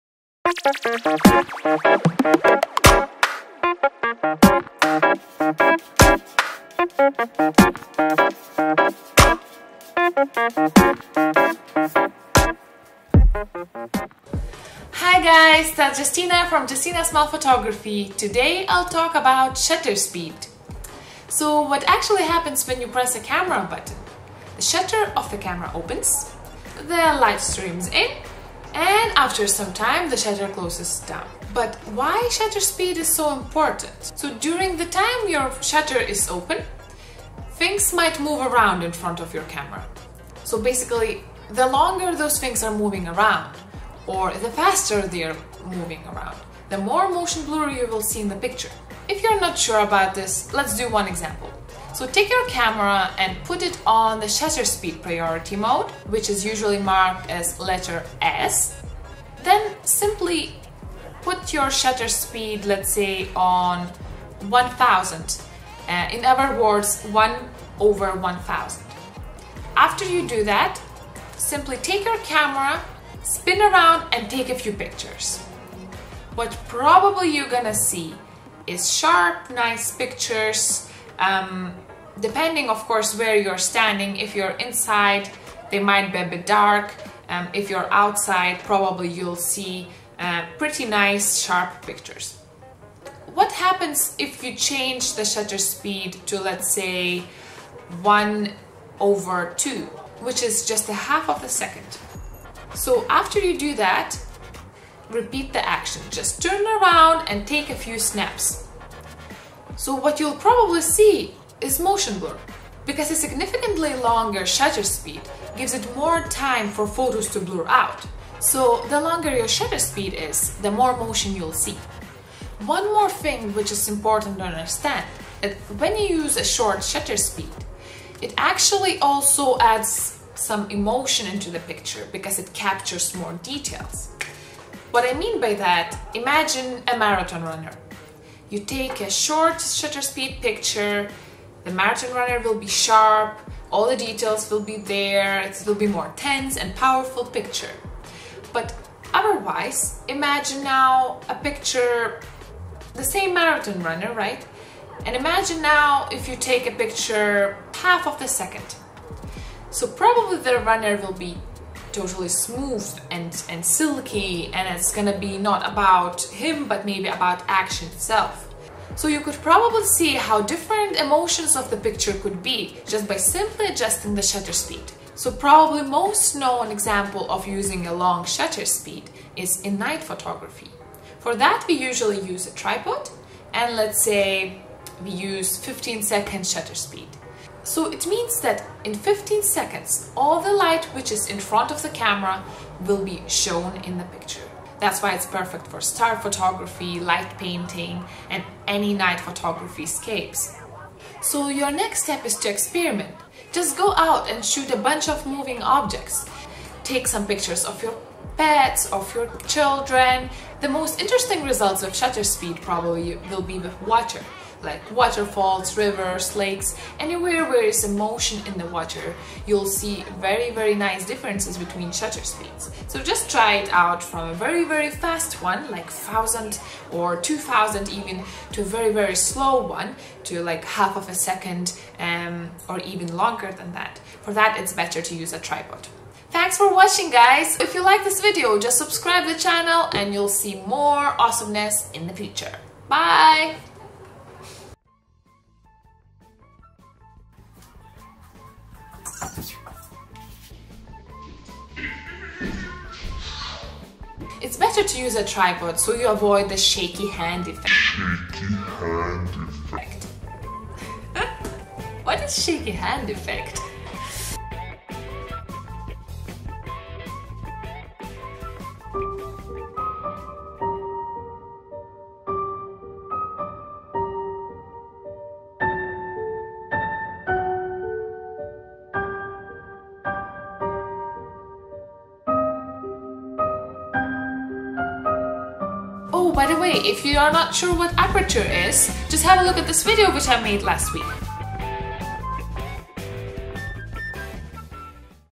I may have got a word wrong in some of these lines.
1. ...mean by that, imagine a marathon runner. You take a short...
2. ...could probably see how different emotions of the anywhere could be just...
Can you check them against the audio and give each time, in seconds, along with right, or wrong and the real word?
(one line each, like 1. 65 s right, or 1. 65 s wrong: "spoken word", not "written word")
1. 135 s right
2. 169 s wrong: "picture", not "anywhere".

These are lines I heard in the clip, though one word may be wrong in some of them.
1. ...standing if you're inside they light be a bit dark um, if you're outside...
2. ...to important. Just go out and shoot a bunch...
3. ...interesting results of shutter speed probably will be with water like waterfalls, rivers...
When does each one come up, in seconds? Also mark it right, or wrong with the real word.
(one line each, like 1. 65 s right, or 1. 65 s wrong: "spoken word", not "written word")
1. 83 s wrong: "might", not "light"
2. 202 s wrong: "experiment", not "important"
3. 211 s right.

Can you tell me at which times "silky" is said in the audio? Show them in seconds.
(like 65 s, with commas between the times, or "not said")
163 s.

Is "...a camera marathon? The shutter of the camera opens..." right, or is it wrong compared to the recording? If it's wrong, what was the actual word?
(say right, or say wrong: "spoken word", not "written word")
wrong: "button", not "marathon".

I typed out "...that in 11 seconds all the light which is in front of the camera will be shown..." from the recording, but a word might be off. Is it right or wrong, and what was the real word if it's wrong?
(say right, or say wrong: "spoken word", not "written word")
wrong: "15", not "11".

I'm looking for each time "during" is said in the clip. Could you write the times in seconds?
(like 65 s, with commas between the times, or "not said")
34 s.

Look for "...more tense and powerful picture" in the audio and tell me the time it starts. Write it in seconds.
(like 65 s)
145 s.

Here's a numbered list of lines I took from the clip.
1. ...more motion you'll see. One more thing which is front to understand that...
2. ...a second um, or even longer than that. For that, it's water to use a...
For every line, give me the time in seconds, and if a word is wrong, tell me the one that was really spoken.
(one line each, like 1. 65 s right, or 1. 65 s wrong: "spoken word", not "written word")
1. 120 s wrong: "important", not "front"
2. 231 s wrong: "better", not "water".